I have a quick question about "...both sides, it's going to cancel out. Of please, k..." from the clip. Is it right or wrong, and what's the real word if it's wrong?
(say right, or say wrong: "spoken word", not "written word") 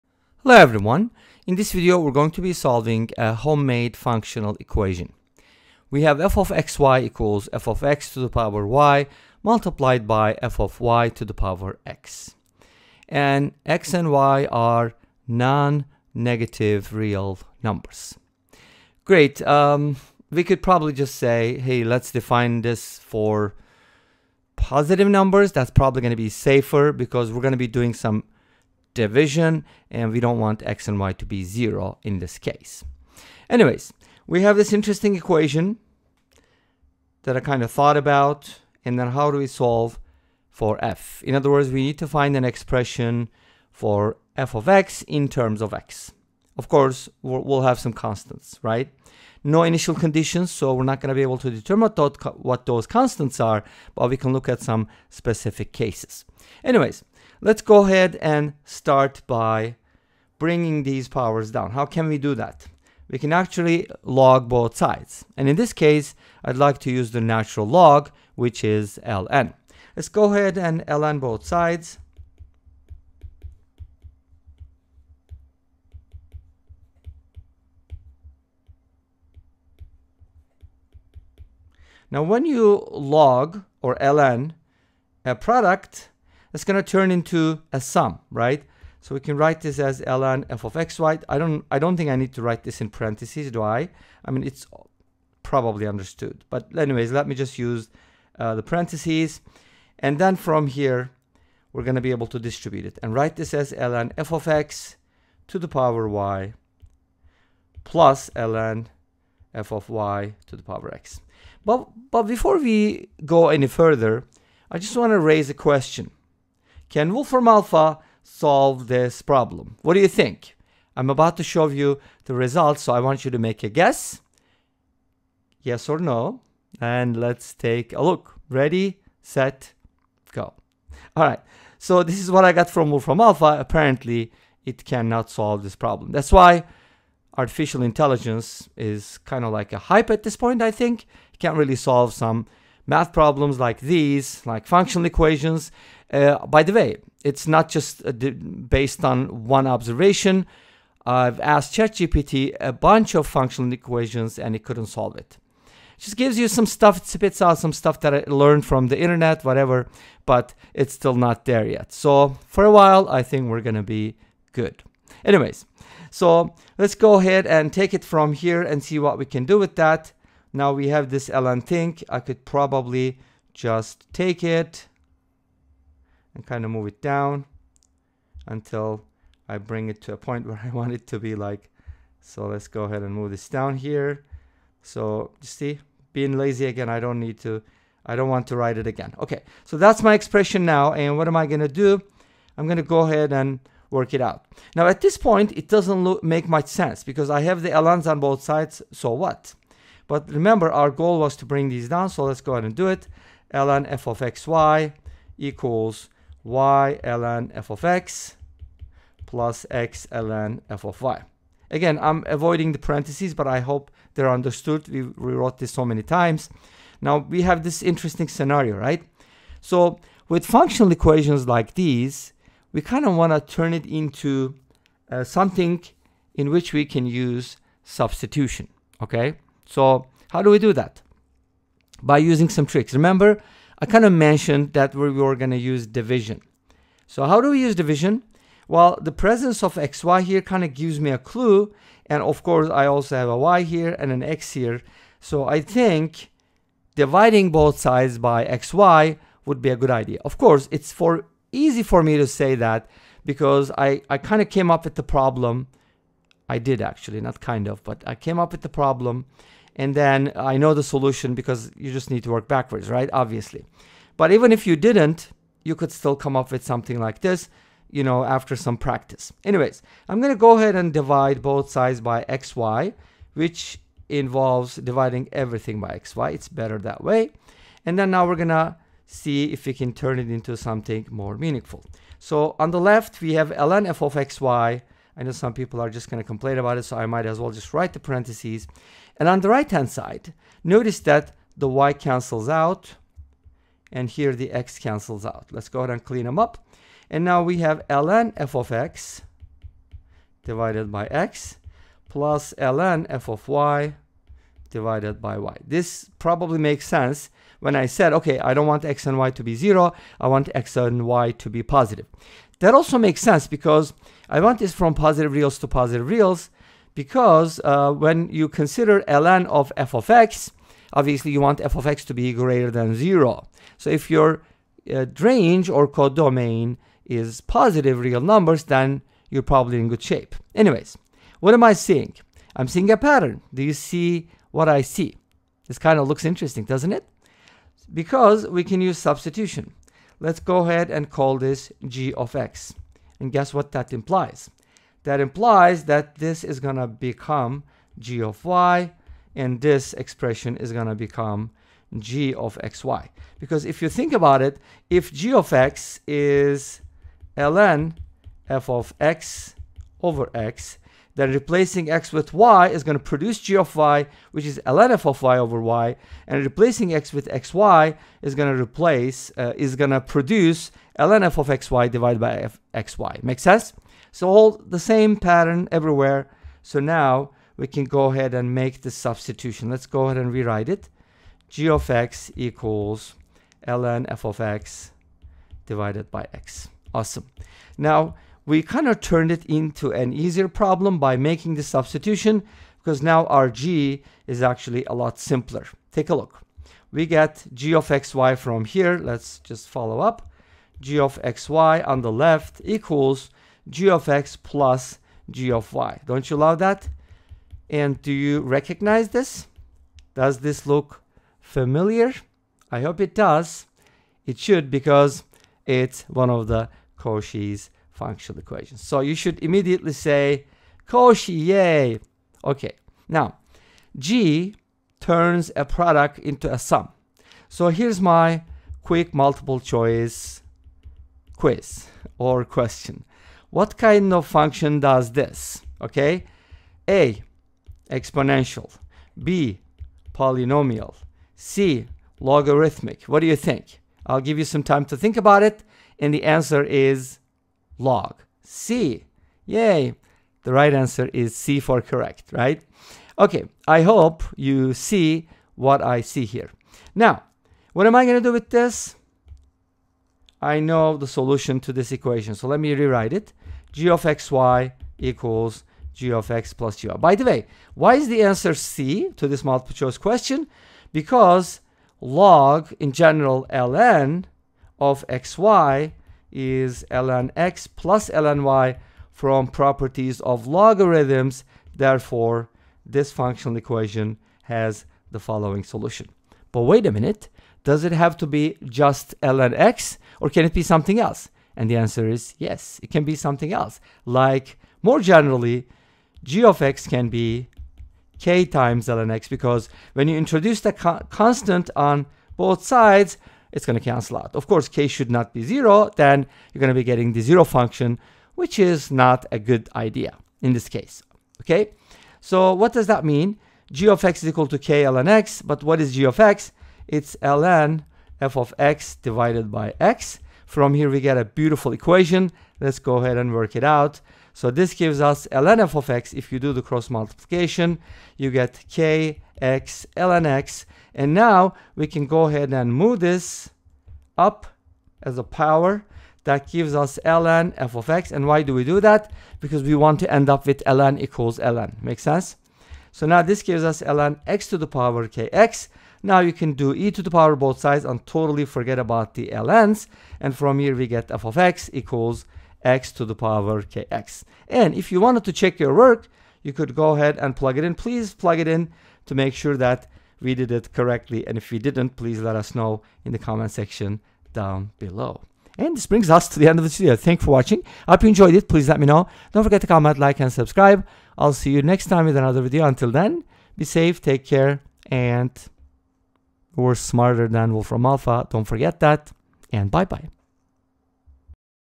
wrong: "course", not "please".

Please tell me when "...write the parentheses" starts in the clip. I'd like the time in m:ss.
4:47.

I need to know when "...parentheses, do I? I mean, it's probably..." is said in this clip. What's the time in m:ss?
1:32.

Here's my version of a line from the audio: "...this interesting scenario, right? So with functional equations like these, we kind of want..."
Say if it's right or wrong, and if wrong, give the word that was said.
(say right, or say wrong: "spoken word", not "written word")
right.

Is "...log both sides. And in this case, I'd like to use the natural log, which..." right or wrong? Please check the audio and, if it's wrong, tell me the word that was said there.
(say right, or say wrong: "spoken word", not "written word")
right.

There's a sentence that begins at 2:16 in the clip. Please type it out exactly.
That's why artificial intelligence is kind of like a hype at this point, I think.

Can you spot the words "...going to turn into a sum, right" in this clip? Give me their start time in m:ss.
1:26.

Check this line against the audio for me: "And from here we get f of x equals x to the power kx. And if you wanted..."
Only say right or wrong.
right.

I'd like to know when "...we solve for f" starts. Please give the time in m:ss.
0:39.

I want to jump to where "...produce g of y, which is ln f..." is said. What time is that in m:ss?
6:03.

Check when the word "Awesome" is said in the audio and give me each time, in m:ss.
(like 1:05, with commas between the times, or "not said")
6:26.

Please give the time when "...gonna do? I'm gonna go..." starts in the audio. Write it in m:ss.
3:11.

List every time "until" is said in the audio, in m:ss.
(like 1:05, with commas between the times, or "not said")
2:58, 9:32.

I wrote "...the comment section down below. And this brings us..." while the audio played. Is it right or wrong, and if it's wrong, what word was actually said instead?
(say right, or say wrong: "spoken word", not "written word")
right.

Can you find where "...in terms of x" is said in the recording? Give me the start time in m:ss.
0:45.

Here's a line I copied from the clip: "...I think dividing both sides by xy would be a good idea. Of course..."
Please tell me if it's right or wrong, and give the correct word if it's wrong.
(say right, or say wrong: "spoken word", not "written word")
right.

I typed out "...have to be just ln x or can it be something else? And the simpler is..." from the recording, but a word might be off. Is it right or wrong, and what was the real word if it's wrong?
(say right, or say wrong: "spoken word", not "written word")
wrong: "answer", not "simpler".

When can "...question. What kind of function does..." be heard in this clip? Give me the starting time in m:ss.
7:12.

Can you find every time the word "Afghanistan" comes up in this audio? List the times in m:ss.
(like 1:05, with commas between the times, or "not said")
not said.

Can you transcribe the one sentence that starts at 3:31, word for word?
Again, I'm avoiding the parentheses, but I hope they're understood.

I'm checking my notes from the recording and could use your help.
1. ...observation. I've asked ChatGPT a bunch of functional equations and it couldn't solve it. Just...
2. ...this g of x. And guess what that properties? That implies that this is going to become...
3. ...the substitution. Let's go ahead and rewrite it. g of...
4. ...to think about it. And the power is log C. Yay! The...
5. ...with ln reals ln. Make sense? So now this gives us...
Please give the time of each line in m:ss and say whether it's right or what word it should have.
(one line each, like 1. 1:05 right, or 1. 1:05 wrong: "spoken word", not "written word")
1. 2:29 right
2. 5:41 wrong: "implies", not "properties"
3. 6:18 right
4. 7:24 wrong: "answer", not "power"
5. 9:00 wrong: "equals", not "reals".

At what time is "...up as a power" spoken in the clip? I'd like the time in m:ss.
8:54.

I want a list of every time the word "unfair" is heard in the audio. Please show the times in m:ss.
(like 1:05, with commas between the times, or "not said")
not said.